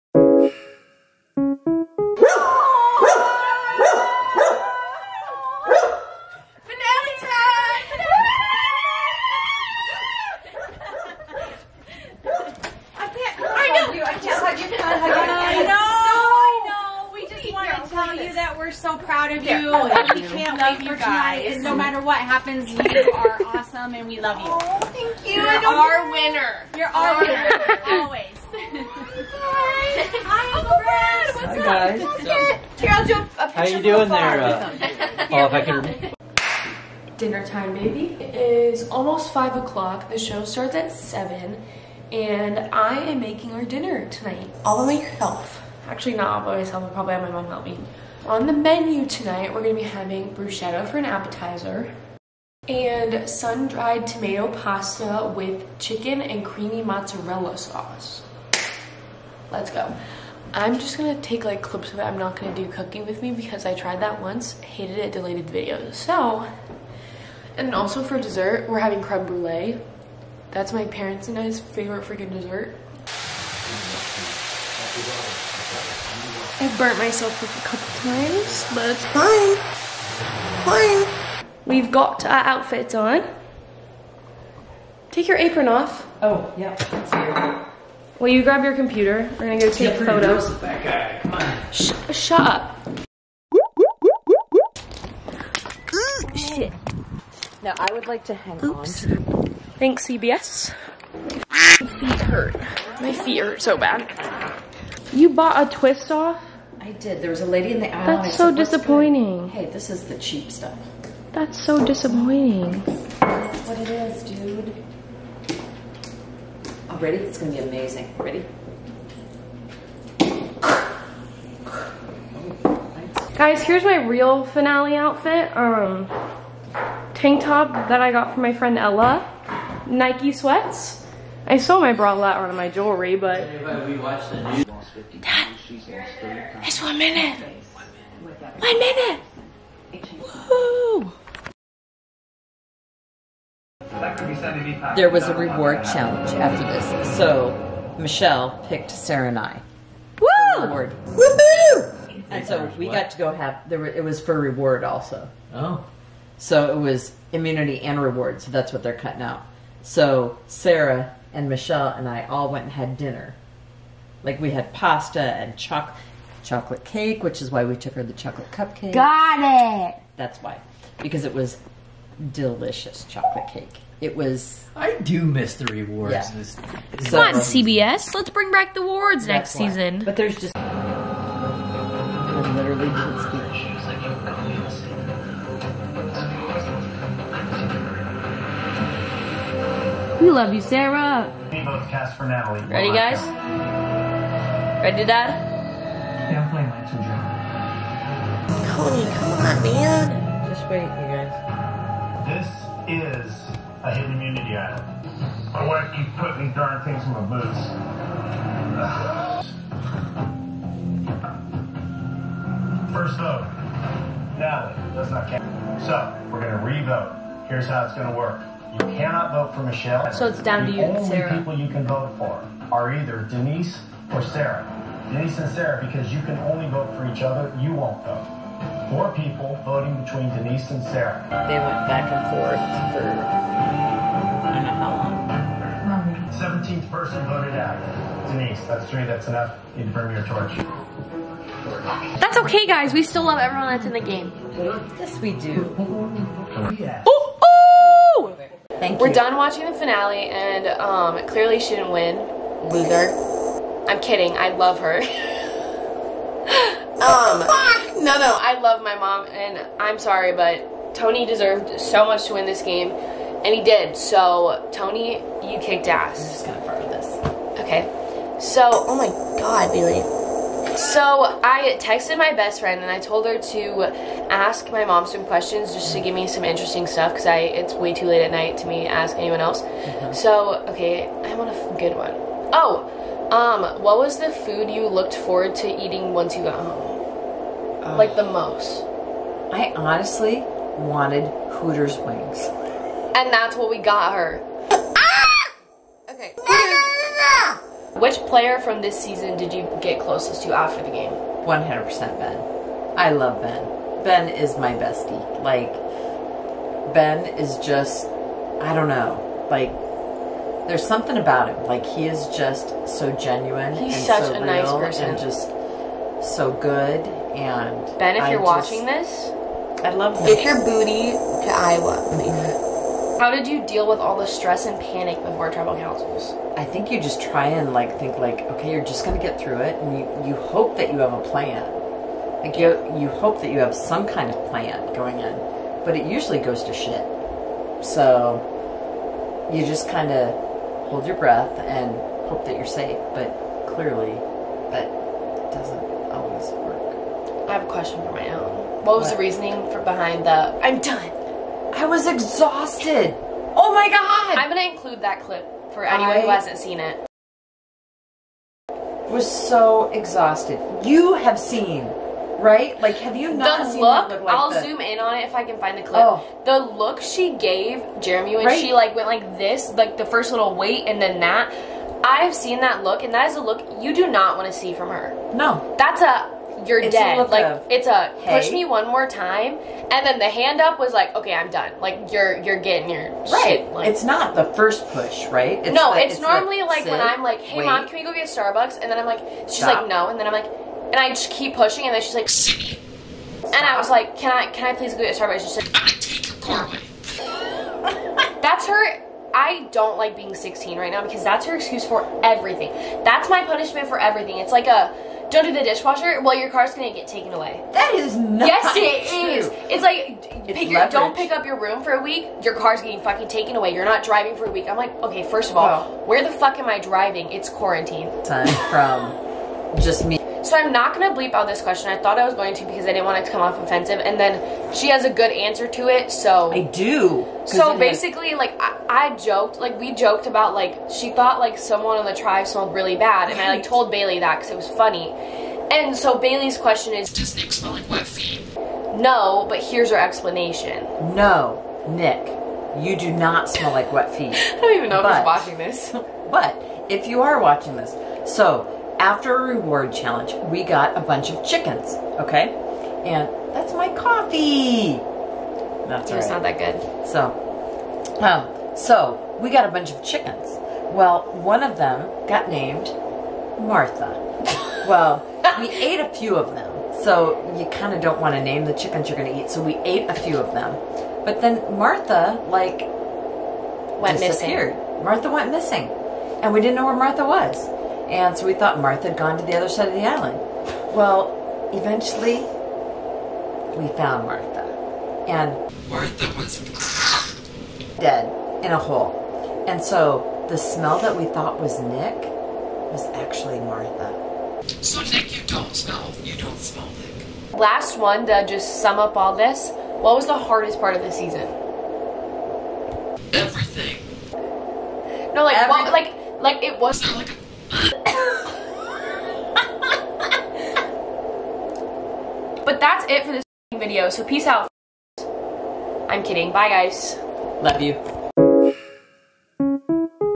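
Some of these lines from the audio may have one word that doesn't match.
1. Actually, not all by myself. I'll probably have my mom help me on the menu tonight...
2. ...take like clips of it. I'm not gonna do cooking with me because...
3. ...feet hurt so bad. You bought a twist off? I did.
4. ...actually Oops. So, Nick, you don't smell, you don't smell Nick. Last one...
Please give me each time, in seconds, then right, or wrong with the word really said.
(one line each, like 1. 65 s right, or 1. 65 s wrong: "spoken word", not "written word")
1. 45 s right
2. 61 s right
3. 103 s right
4. 493 s wrong: "Martha", not "Oops".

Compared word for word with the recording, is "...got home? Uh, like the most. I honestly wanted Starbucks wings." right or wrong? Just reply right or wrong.
wrong.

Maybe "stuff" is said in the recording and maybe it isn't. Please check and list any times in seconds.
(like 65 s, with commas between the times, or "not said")
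110 s, 276 s.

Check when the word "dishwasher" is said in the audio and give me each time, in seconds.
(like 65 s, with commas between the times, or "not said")
405 s.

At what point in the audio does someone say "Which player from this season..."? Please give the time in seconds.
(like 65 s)
297 s.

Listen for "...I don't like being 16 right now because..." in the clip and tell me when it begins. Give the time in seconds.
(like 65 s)
399 s.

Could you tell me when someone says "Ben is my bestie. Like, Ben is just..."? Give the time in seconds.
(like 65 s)
304 s.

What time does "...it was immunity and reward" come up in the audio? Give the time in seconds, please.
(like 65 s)
156 s.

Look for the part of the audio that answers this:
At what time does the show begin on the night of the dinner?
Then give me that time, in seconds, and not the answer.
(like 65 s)
40 s.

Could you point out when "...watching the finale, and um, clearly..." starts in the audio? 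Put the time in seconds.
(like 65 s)
249 s.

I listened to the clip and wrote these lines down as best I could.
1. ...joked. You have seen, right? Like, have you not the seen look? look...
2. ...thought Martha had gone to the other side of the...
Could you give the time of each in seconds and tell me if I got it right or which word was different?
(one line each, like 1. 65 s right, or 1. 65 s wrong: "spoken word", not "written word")
1. 359 s wrong: "exhausted", not "joked"
2. 478 s right.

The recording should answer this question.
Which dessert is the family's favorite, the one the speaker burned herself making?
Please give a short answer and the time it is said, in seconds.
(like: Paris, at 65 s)
Creme brulee, at 69 s.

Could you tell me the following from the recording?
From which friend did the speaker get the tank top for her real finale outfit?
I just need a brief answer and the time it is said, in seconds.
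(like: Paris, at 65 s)
Ella, at 128 s.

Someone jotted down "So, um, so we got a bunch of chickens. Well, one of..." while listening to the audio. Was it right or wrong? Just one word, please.
right.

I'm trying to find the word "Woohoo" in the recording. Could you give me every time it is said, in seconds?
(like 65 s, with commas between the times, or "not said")
151 s.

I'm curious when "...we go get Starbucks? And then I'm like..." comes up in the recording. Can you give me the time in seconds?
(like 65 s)
387 s.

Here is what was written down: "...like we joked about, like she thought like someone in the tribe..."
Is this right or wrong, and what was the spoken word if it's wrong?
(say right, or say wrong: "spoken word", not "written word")
right.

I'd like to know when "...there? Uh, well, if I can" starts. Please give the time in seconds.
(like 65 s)
34 s.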